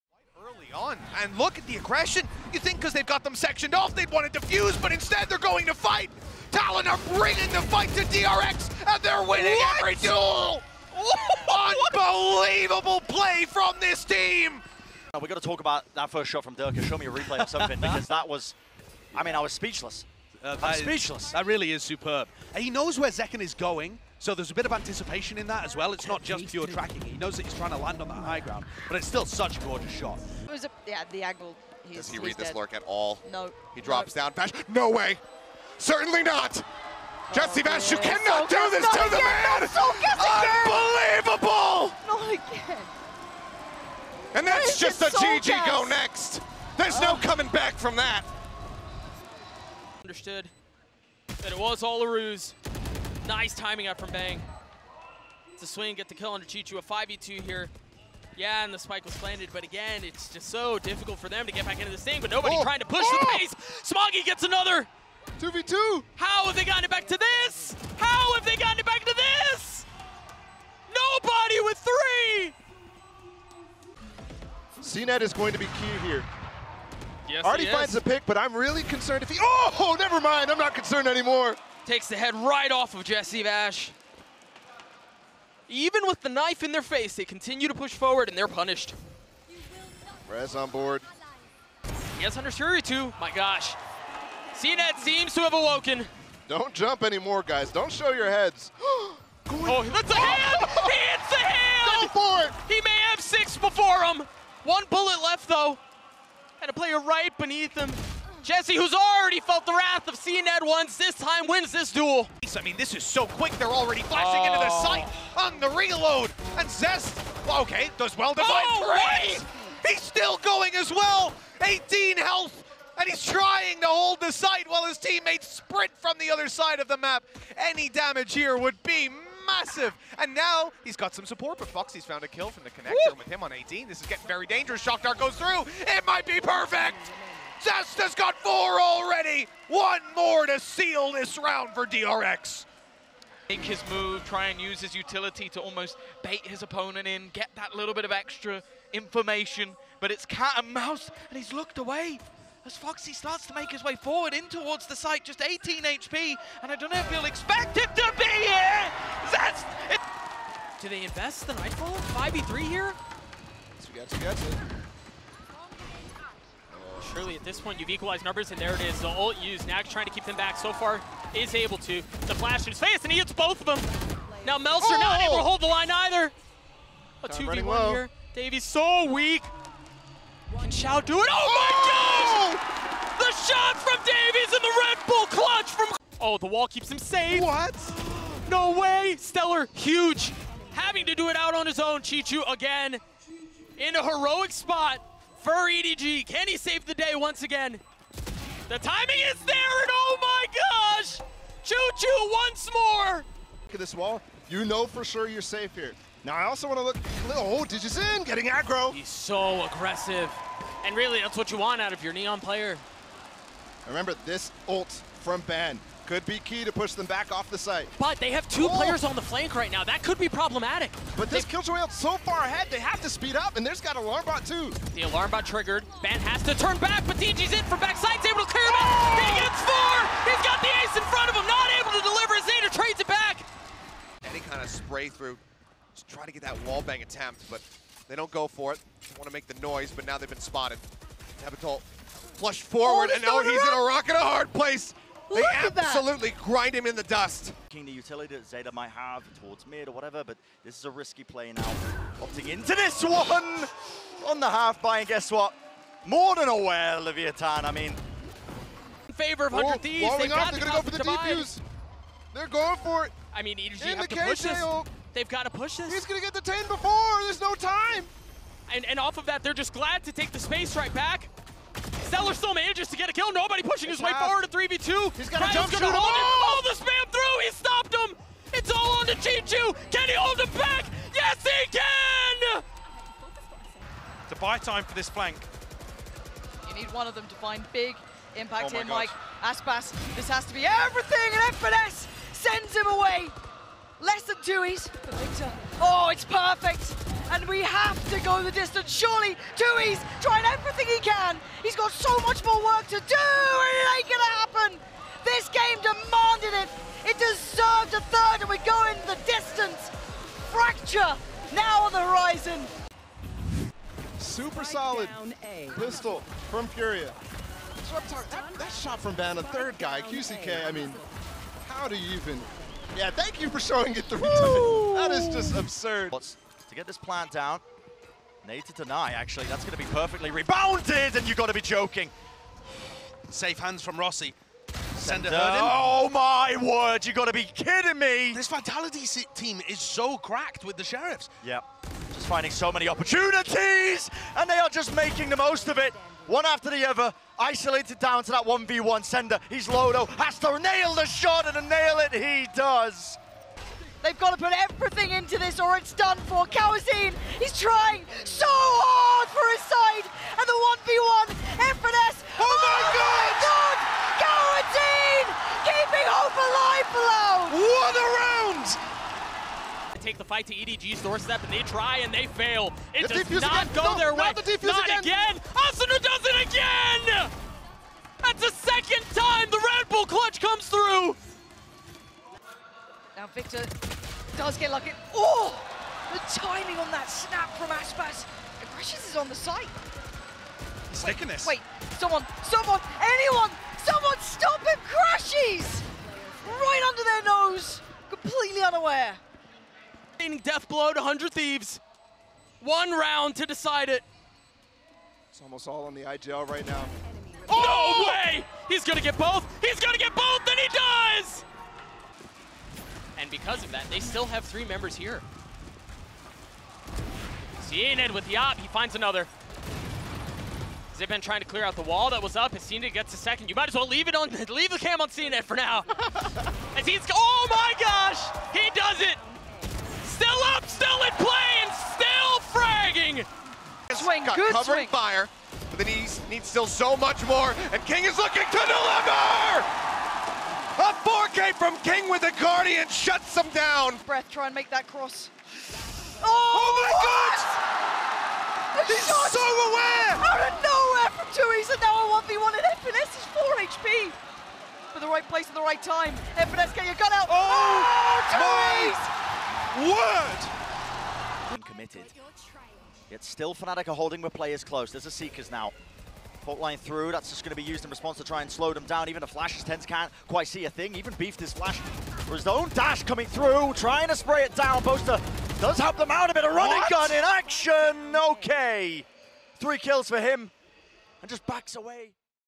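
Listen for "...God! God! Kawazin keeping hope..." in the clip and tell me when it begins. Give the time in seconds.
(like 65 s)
362 s.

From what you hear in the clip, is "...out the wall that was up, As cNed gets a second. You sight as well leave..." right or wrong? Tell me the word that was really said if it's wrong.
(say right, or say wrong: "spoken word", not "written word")
wrong: "might", not "sight".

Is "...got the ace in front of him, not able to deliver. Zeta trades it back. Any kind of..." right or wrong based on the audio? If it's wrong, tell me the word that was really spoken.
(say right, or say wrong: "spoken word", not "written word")
right.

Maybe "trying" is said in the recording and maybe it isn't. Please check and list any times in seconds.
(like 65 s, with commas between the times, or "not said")
27 s, 62 s, 123 s, 169 s, 300 s, 357 s, 421 s, 473 s.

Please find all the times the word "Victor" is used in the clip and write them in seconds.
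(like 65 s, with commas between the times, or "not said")
294 s, 383 s.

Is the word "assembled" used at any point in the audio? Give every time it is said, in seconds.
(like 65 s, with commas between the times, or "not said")
not said.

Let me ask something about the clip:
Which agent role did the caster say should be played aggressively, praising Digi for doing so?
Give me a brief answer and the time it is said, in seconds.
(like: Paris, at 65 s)
Neon, at 212 s.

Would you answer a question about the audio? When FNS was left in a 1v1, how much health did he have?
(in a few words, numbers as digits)
4 HP.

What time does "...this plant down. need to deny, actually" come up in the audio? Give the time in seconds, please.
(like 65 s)
326 s.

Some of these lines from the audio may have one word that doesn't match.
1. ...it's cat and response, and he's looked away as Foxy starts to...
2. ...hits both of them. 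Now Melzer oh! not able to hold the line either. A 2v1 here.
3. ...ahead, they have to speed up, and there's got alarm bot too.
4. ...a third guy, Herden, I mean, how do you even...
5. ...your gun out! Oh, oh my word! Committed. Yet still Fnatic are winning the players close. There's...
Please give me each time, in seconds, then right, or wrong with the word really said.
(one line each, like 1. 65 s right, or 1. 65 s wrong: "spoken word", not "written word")
1. 150 s wrong: "mouse", not "response"
2. 173 s right
3. 222 s right
4. 319 s wrong: "QCK", not "Herden"
5. 456 s wrong: "holding", not "winning".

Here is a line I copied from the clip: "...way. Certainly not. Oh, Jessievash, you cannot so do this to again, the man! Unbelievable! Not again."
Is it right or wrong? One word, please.
right.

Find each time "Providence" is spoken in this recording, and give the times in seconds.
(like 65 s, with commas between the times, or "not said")
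not said.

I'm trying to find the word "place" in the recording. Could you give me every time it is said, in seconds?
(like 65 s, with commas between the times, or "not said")
244 s, 455 s.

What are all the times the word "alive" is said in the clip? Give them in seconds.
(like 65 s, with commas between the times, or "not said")
366 s.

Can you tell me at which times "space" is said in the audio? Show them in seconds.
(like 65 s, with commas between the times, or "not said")
270 s.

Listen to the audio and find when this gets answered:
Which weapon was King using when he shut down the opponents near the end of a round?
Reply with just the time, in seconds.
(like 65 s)
442 s.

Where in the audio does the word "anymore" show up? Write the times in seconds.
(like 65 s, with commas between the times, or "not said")
81 s, 97 s.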